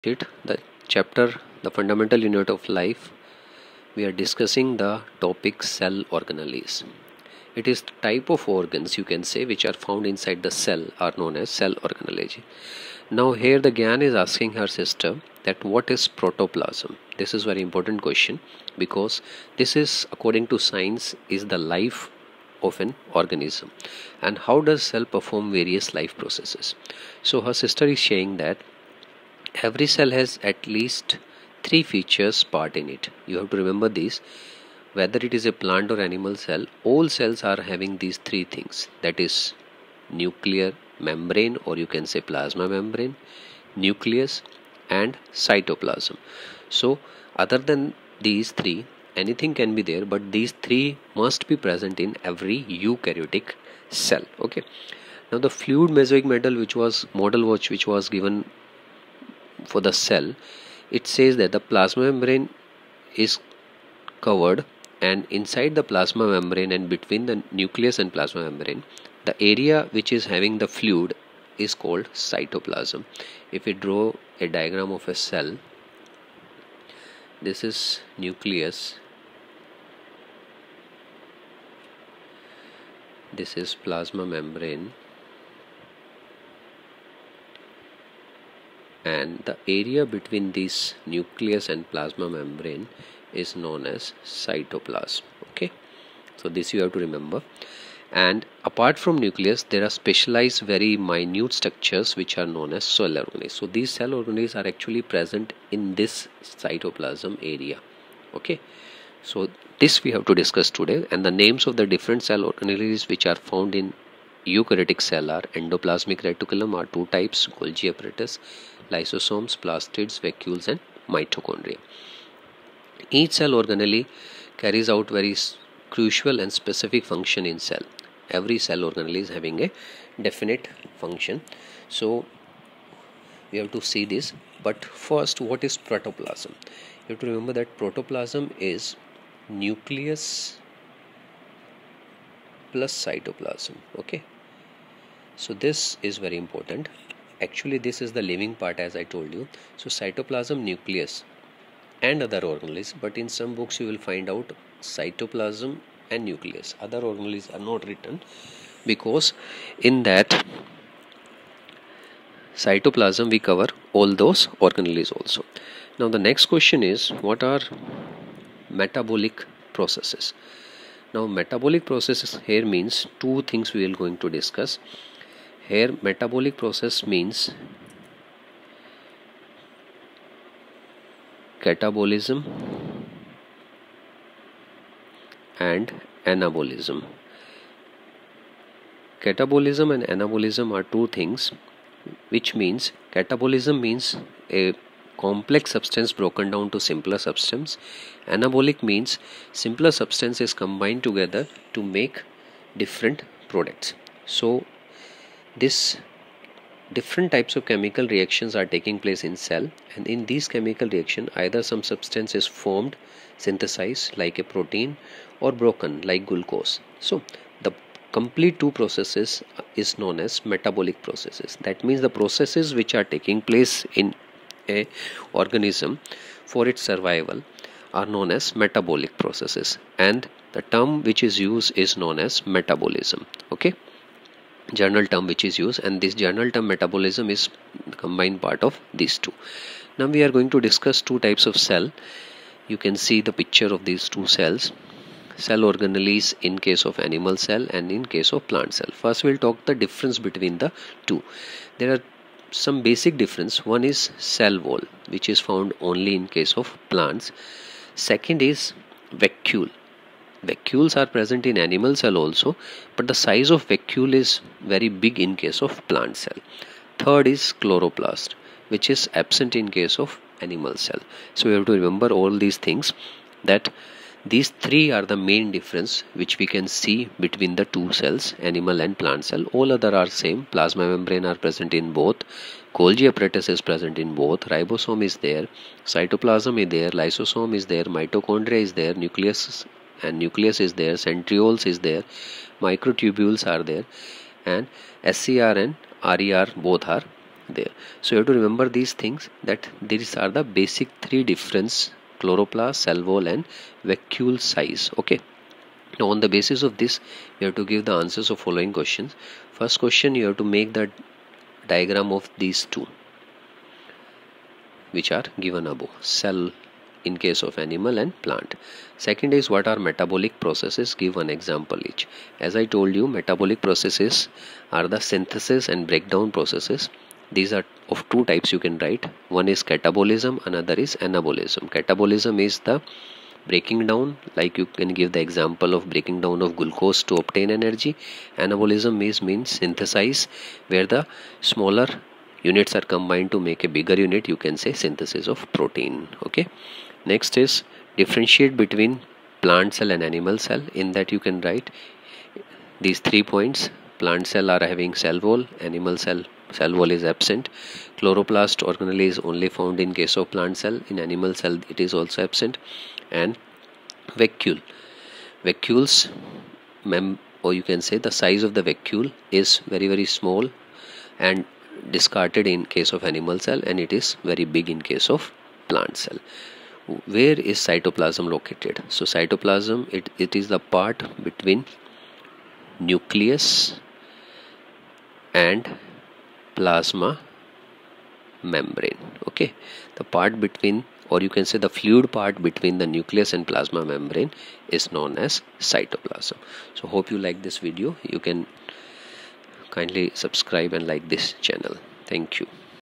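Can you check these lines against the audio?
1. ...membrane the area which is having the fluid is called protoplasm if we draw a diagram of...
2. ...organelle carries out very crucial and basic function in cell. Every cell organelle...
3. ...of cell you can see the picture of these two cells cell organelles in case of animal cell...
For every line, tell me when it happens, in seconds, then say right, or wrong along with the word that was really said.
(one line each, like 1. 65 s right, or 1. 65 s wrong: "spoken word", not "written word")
1. 68 s wrong: "cytoplasm", not "protoplasm"
2. 123 s wrong: "specific", not "basic"
3. 241 s right.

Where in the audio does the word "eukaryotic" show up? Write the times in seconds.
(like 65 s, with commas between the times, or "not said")
52 s, 114 s.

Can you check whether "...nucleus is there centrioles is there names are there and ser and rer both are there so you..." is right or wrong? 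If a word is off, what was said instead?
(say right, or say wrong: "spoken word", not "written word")
wrong: "microtubules", not "names".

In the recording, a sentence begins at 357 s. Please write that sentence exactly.
Chloroplast organelle is only found in case of plant cell.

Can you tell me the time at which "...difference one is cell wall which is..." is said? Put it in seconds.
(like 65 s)
253 s.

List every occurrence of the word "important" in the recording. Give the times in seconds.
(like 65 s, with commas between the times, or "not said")
17 s, 146 s.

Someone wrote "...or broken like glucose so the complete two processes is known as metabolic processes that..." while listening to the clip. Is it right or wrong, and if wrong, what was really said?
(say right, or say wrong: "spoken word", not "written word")
right.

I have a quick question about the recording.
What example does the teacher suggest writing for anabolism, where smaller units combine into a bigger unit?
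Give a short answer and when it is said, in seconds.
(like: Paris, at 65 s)
Synthesis of protein, at 344 s.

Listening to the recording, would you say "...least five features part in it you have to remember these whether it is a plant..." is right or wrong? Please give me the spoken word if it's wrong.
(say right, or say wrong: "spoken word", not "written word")
wrong: "three", not "five".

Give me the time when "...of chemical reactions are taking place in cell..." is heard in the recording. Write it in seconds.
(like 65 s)
207 s.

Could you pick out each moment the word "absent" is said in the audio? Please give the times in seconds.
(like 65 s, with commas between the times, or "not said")
269 s, 357 s, 362 s.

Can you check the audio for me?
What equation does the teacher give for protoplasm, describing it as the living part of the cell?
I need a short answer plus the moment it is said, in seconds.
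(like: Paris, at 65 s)
nucleus plus cytoplasm, at 139 s.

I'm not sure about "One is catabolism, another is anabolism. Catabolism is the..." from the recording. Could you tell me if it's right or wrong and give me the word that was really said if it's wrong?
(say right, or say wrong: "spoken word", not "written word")
right.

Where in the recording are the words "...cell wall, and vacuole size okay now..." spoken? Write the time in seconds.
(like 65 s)
302 s.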